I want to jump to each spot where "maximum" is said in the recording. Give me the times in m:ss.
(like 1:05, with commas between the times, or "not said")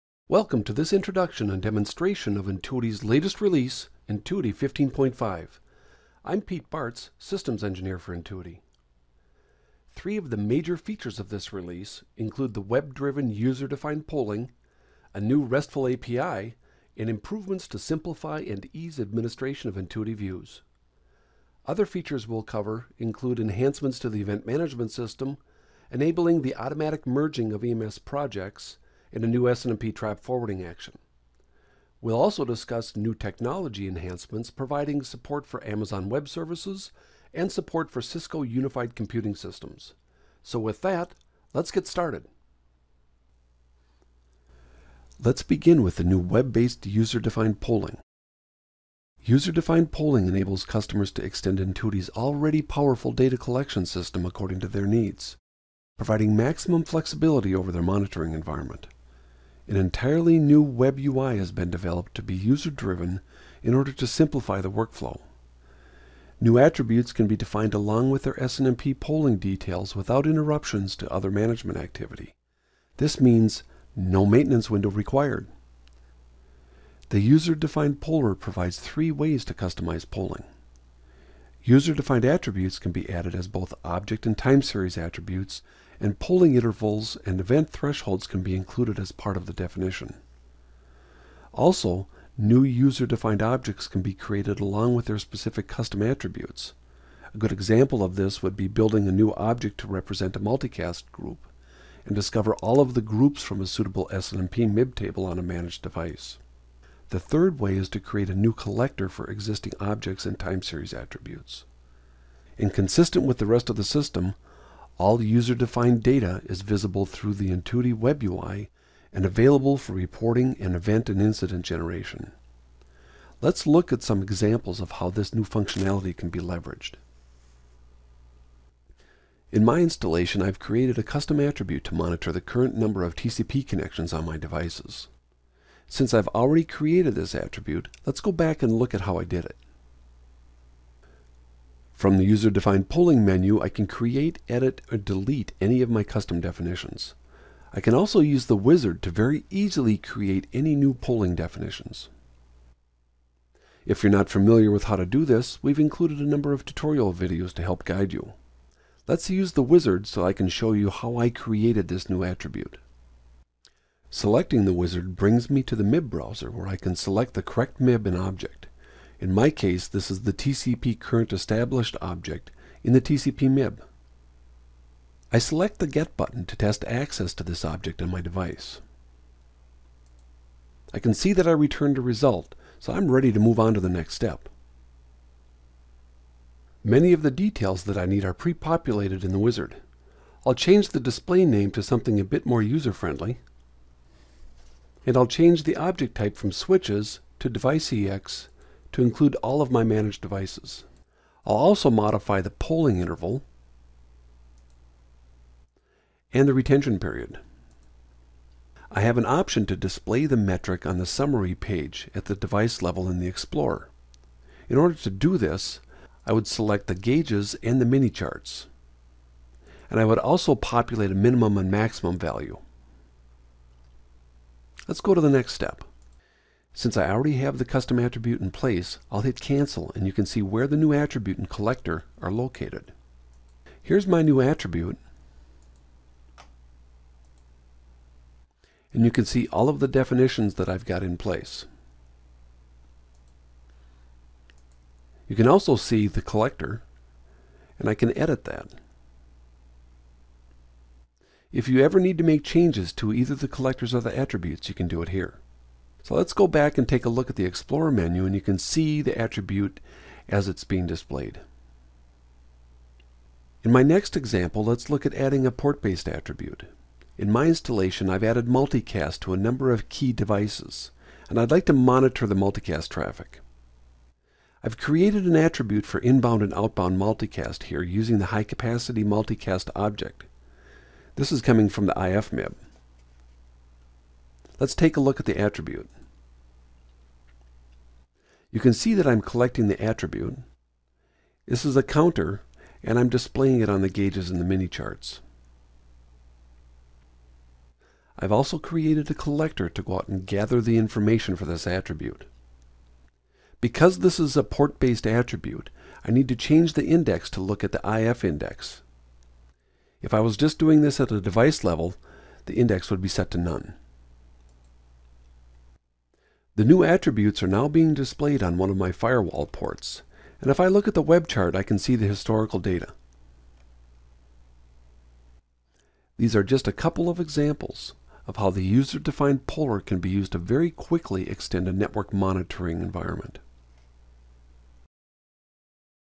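0:56, 3:41.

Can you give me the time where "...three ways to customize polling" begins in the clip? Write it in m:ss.
1:18.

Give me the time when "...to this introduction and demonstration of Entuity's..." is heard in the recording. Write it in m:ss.
0:00.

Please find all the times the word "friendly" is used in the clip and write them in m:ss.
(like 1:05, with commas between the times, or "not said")
3:12.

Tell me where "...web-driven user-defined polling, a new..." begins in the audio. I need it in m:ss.
0:12.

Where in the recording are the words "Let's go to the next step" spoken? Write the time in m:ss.
3:44.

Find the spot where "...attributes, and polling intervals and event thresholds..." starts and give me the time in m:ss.
1:24.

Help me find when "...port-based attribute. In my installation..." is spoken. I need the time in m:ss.
4:25.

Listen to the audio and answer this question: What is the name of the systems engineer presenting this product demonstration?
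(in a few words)
Pete Bartz.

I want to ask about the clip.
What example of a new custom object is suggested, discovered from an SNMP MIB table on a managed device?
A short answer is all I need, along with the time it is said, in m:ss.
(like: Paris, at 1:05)
multicast group, at 1:40.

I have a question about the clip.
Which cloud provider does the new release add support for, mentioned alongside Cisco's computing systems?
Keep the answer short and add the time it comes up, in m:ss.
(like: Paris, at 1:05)
Amazon Web Services, at 0:35.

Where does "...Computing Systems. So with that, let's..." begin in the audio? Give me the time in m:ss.
0:38.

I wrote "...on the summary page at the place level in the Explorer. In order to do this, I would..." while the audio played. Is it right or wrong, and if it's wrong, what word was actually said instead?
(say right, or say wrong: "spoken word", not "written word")
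wrong: "device", not "place".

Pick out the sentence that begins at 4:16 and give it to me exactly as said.
So let's go back and take a look at the Explorer menu and you can see the attribute as it's being displayed.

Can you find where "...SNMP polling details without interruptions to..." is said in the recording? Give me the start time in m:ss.
1:08.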